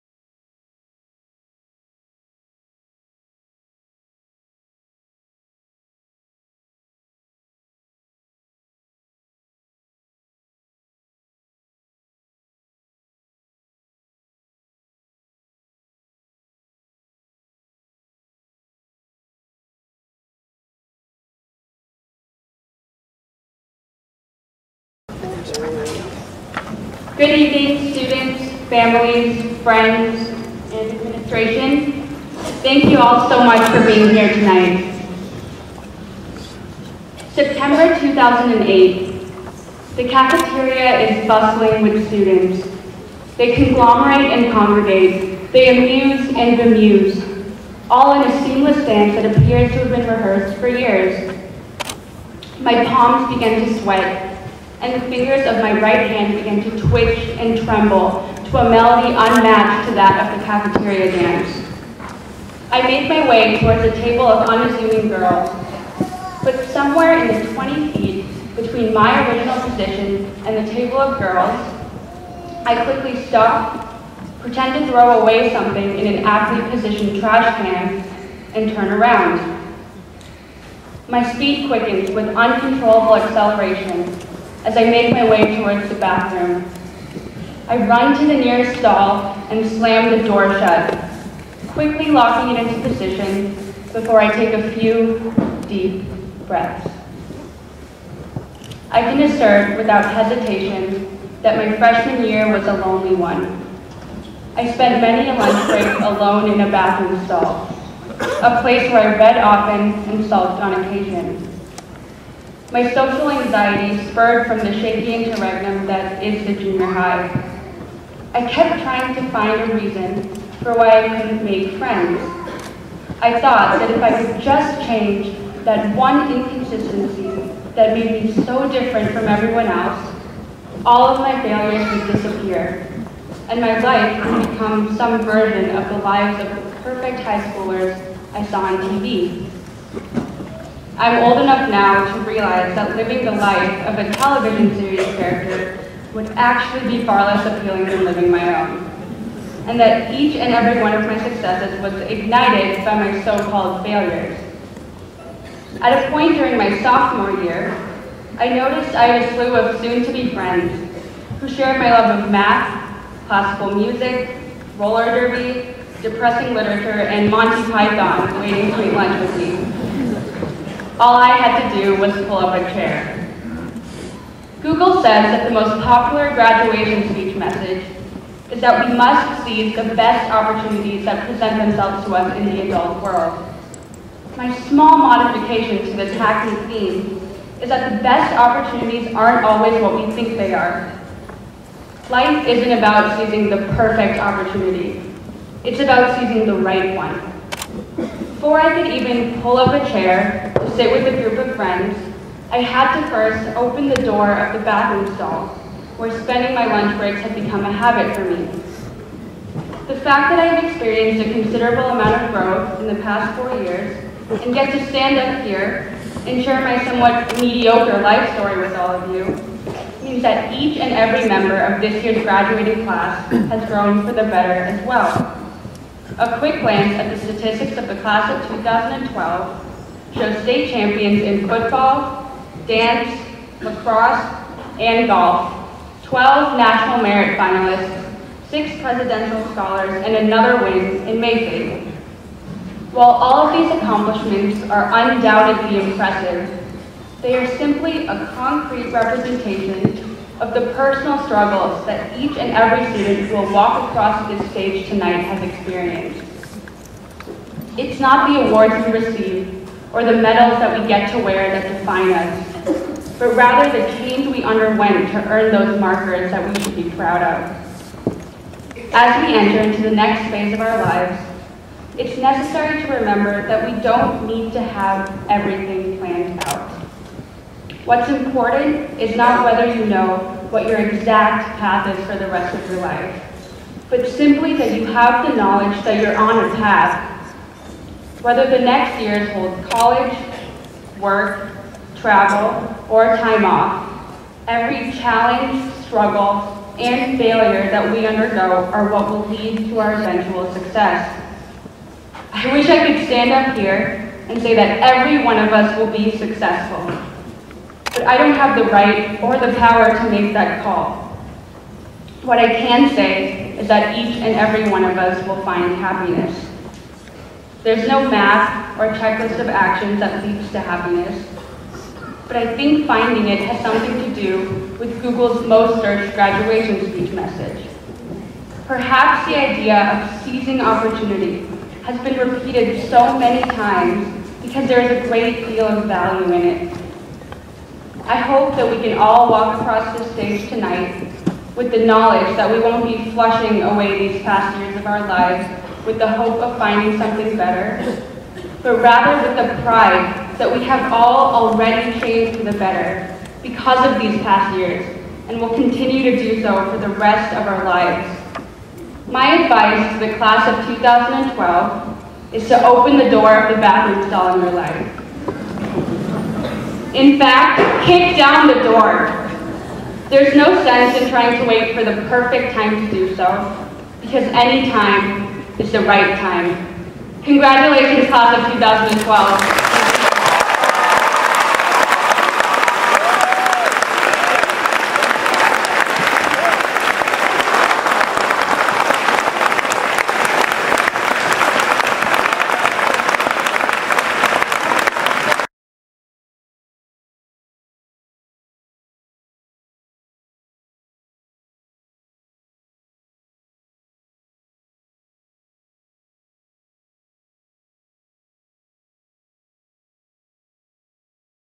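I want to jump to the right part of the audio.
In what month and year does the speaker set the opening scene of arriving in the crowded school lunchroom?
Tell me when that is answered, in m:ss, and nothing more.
0:37.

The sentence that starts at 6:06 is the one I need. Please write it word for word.
In fact, kick down the door.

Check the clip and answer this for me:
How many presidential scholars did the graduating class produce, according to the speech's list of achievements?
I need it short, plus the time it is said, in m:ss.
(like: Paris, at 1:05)
6, at 3:58.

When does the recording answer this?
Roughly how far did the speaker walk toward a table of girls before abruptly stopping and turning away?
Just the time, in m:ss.
1:07.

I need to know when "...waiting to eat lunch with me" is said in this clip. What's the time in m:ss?
2:48.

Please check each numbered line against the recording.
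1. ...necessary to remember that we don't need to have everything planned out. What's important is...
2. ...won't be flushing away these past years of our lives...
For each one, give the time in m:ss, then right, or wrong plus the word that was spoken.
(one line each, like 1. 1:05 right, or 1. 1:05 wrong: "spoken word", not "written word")
1. 4:32 right
2. 5:42 right.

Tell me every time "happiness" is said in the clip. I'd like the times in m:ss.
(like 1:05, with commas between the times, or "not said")
5:15, 5:20.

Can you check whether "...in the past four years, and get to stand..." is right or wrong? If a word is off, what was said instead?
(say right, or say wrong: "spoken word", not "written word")
right.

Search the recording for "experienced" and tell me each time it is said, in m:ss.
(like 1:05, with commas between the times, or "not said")
3:30, 4:15.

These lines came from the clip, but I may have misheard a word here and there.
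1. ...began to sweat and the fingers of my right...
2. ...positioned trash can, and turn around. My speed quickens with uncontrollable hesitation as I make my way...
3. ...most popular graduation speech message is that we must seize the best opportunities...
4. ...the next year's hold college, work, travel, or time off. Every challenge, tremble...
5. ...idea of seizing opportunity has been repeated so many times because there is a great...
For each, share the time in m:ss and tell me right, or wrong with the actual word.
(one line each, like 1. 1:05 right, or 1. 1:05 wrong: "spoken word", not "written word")
1. 0:53 right
2. 1:16 wrong: "acceleration", not "hesitation"
3. 2:55 right
4. 4:48 wrong: "struggle", not "tremble"
5. 5:29 right.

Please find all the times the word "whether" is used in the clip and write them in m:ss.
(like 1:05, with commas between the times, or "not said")
4:39, 4:48.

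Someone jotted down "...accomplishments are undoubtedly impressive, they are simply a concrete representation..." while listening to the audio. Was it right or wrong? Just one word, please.
right.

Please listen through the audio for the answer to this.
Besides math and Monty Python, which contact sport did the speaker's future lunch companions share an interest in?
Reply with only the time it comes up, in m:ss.
2:44.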